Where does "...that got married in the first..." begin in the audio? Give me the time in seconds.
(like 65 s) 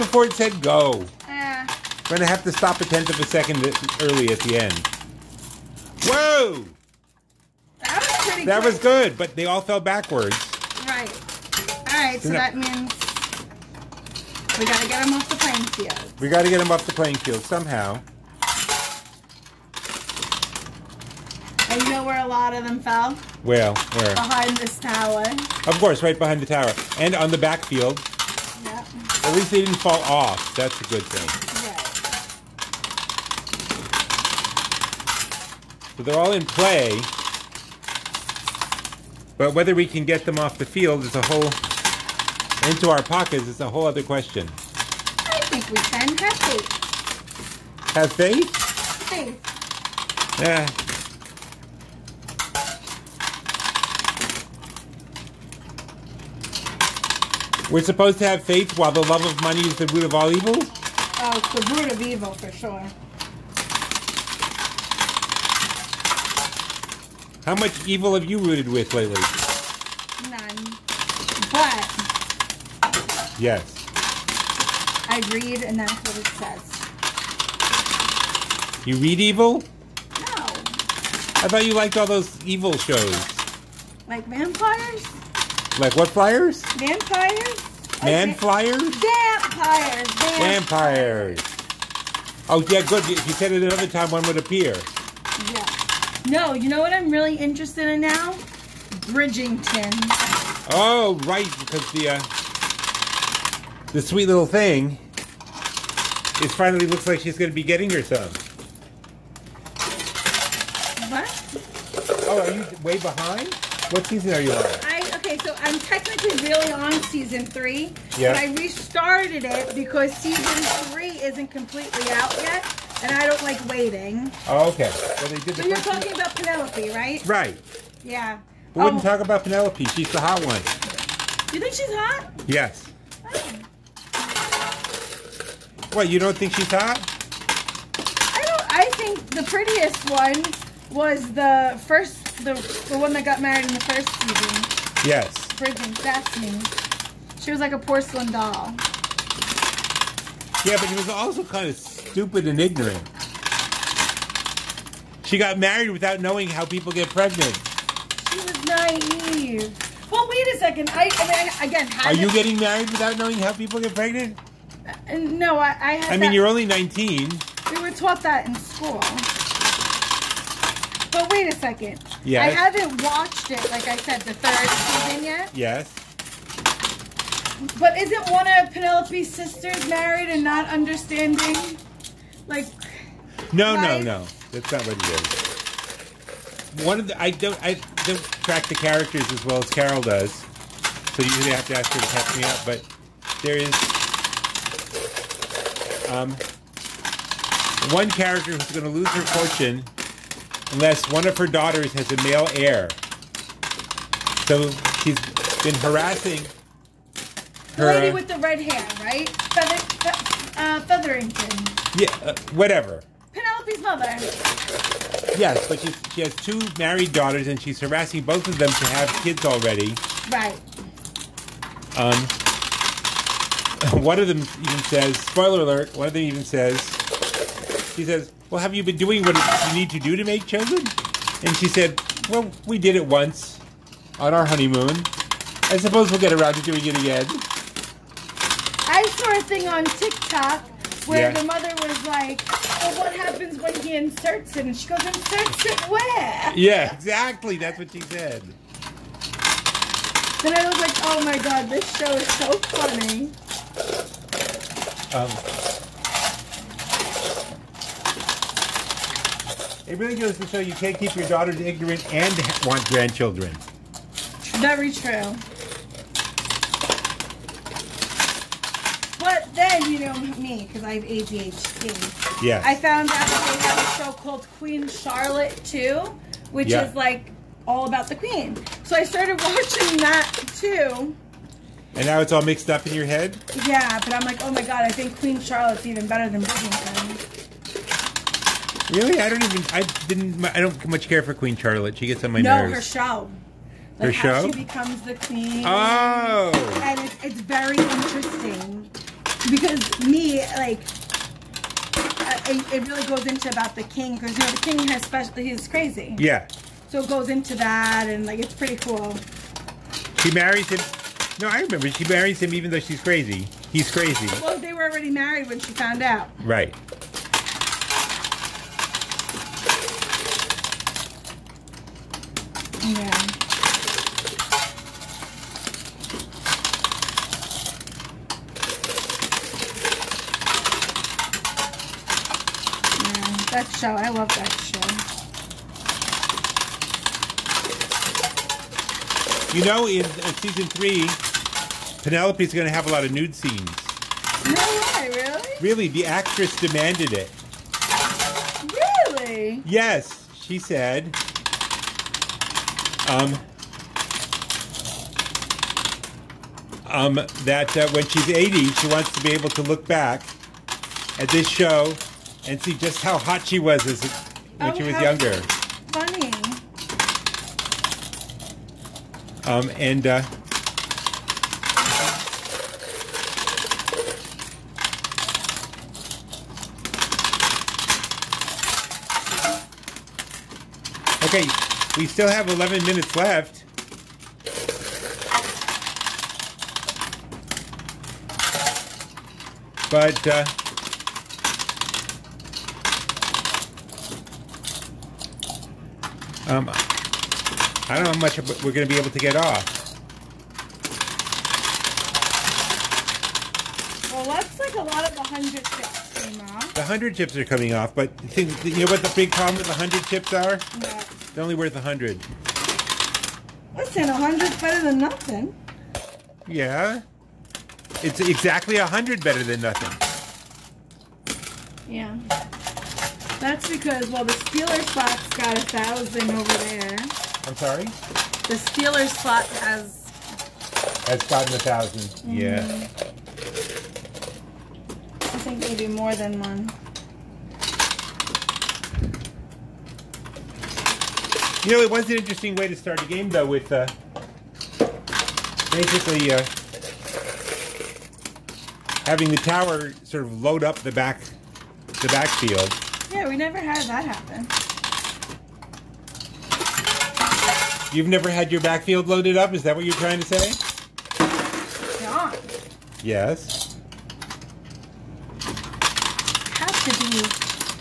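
143 s.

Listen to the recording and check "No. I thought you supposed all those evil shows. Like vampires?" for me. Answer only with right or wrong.
wrong.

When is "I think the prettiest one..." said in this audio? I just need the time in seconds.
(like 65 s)
138 s.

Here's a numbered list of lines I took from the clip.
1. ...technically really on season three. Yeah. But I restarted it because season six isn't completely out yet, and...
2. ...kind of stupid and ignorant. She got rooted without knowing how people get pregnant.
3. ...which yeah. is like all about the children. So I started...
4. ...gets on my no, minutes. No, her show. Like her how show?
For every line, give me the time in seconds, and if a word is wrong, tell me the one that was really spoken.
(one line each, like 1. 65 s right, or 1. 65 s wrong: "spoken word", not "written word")
1. 115 s wrong: "three", not "six"
2. 151 s wrong: "married", not "rooted"
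3. 276 s wrong: "queen", not "children"
4. 292 s wrong: "nerves", not "minutes".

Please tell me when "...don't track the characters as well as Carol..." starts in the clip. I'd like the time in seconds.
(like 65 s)
188 s.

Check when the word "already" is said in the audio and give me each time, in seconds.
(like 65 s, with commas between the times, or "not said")
219 s, 314 s.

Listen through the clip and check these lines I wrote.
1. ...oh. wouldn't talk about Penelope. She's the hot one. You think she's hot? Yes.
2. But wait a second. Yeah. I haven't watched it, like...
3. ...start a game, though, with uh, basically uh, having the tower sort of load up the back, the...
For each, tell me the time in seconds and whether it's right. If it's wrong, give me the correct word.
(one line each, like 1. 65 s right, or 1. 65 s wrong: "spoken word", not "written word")
1. 128 s right
2. 171 s right
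3. 442 s right.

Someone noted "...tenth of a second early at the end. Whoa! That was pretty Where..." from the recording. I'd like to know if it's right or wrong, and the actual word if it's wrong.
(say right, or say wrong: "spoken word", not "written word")
wrong: "That", not "Where".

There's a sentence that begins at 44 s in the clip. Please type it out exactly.
I think we can have faith.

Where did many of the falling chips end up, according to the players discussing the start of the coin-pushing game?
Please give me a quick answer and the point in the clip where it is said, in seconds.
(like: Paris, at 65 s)
Behind the tower, at 24 s.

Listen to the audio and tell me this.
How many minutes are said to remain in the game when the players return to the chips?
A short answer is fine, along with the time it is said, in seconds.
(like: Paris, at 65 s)
11, at 382 s.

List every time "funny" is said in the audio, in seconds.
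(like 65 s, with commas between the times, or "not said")
252 s.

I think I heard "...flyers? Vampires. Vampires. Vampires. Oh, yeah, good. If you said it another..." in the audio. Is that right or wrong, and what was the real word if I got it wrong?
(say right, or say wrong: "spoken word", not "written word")
right.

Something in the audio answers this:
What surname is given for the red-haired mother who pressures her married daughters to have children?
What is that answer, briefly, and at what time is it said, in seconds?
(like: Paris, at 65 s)
Featherington, at 210 s.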